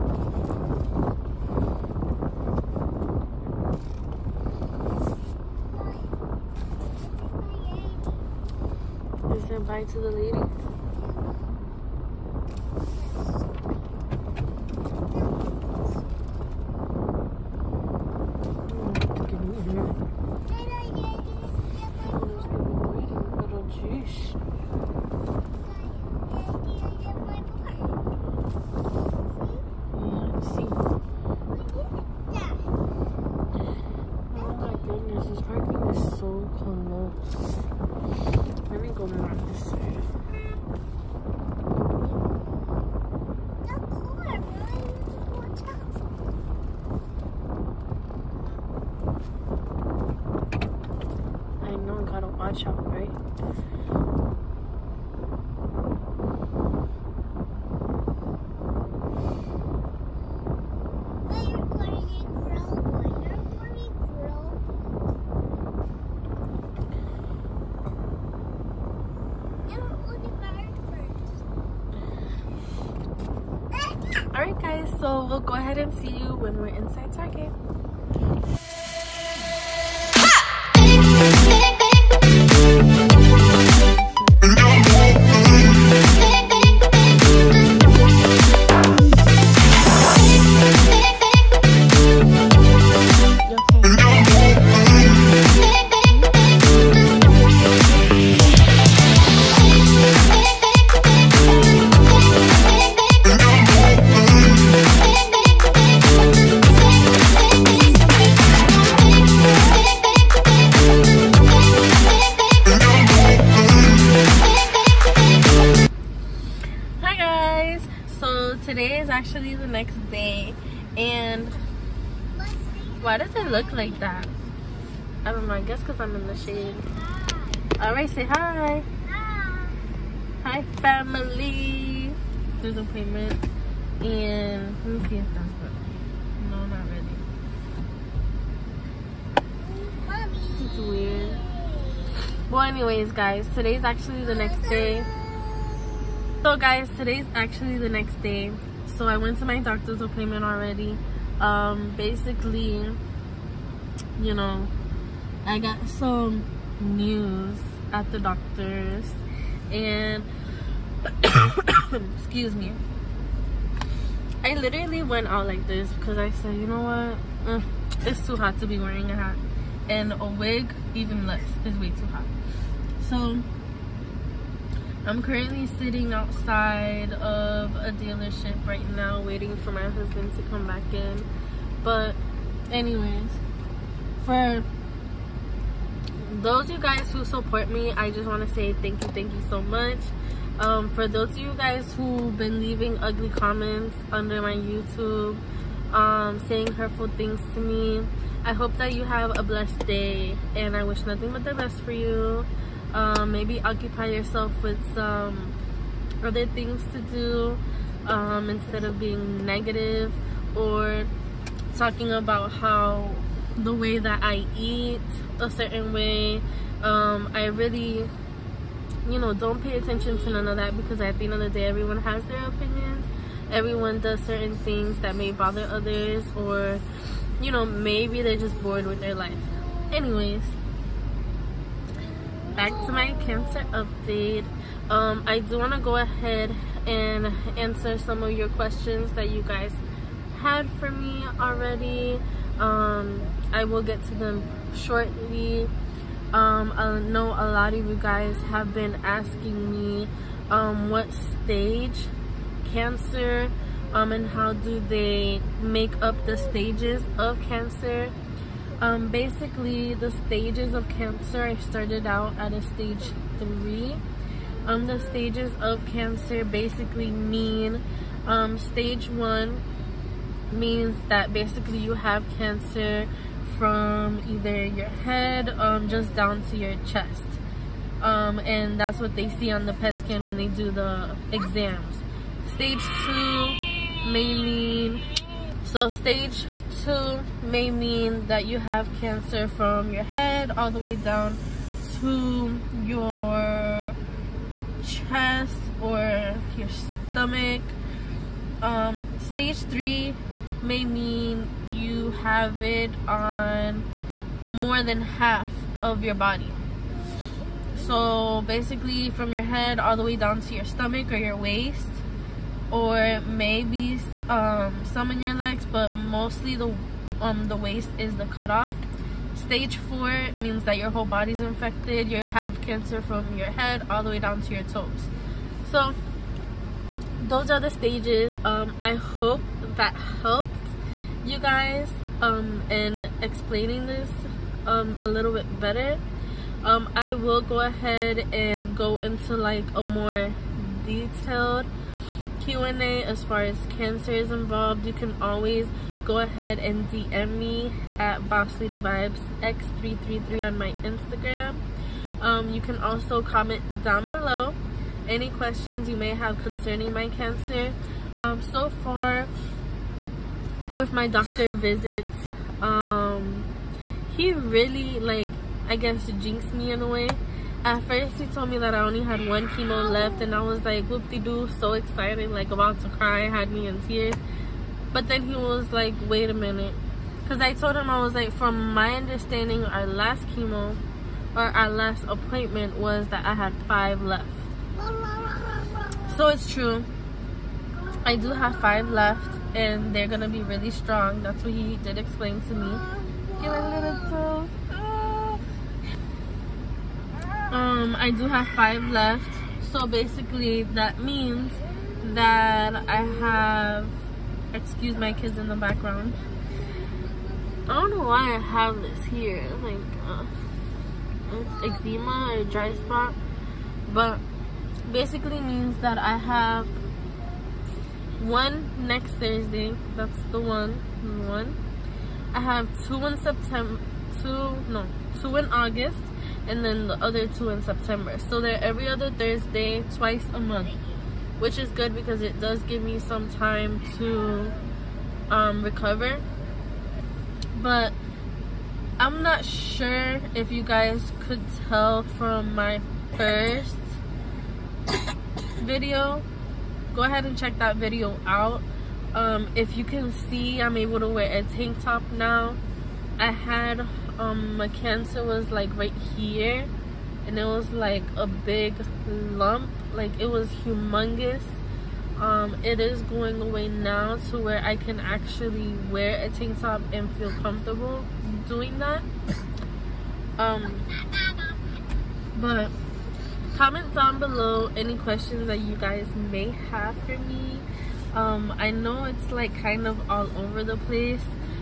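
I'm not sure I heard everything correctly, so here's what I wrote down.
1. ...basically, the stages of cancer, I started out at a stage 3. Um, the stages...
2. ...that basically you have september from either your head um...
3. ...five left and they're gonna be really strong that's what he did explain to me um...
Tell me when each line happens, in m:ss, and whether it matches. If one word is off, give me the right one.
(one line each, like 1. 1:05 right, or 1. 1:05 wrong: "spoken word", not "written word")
1. 4:19 right
2. 4:31 wrong: "cancer", not "september"
3. 6:28 right.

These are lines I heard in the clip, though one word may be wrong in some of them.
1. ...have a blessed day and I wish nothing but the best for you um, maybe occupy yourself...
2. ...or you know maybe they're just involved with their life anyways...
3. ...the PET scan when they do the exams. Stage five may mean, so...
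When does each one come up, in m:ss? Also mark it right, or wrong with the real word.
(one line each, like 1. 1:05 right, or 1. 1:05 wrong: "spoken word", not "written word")
1. 3:19 right
2. 3:46 wrong: "bored", not "involved"
3. 4:39 wrong: "two", not "five".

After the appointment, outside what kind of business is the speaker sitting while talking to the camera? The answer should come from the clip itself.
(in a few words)
A dealership.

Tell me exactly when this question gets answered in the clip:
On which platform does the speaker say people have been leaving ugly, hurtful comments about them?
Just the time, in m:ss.
3:14.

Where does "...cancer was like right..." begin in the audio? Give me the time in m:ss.
7:34.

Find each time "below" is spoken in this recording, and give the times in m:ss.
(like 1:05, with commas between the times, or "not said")
5:54, 7:54.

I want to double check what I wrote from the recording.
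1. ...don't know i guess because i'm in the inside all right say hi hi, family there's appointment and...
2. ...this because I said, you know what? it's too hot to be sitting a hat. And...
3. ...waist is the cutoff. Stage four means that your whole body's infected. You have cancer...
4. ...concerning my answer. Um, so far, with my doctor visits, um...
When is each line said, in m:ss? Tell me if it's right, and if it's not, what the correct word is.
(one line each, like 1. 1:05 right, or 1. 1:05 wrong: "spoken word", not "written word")
1. 2:05 wrong: "shade", not "inside"
2. 2:45 wrong: "wearing", not "sitting"
3. 5:17 right
4. 5:56 wrong: "cancer", not "answer".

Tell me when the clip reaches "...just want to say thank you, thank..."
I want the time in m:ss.
3:08.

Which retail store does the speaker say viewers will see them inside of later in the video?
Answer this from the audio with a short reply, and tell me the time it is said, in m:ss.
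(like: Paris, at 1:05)
Target, at 1:17.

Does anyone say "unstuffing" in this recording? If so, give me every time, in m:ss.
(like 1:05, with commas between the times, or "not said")
not said.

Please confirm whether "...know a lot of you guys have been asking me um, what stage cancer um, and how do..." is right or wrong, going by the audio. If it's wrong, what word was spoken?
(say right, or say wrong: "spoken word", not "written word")
right.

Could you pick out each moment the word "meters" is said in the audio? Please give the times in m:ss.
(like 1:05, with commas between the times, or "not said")
not said.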